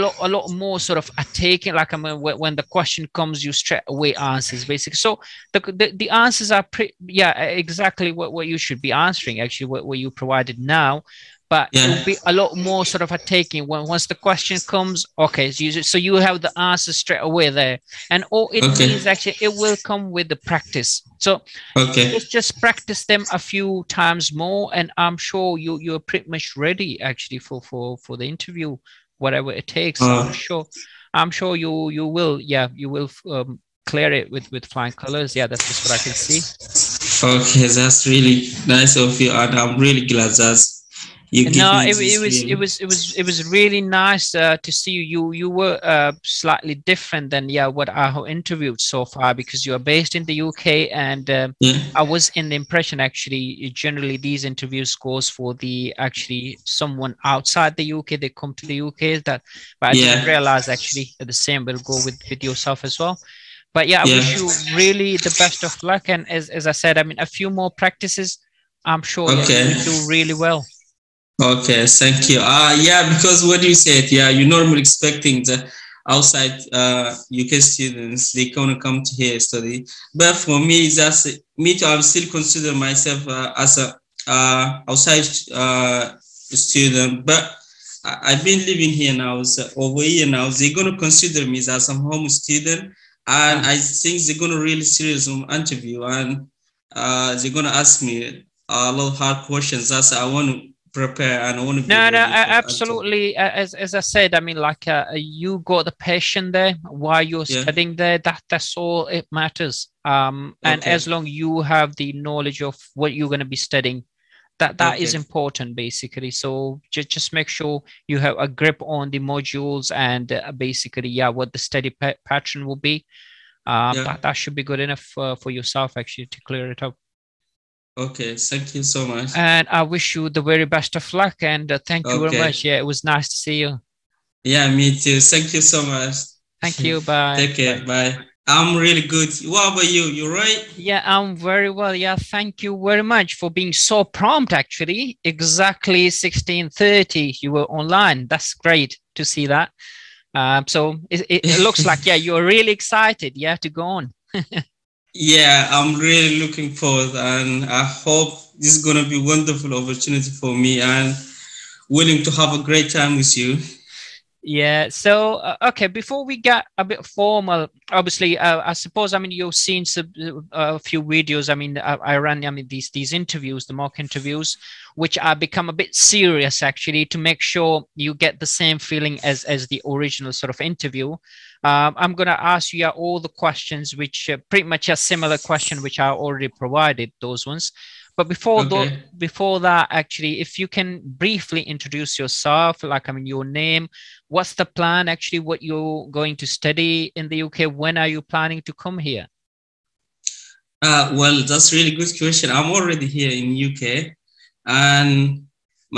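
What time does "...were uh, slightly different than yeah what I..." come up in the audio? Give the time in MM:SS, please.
00:45.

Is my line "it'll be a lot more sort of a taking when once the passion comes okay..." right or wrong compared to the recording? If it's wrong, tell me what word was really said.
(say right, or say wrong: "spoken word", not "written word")
wrong: "question", not "passion".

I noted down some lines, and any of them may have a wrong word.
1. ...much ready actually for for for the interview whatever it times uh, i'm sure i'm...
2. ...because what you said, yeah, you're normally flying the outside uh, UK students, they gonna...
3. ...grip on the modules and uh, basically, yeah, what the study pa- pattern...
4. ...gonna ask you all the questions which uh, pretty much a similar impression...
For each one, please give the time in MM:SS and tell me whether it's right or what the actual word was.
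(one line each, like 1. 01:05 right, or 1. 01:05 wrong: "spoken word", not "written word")
1. 00:26 wrong: "takes", not "times"
2. 01:13 wrong: "expecting", not "flying"
3. 01:58 right
4. 03:02 wrong: "question", not "impression".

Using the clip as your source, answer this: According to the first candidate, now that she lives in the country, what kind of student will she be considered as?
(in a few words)
home student.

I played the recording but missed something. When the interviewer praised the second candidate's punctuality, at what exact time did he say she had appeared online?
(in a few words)
16:30.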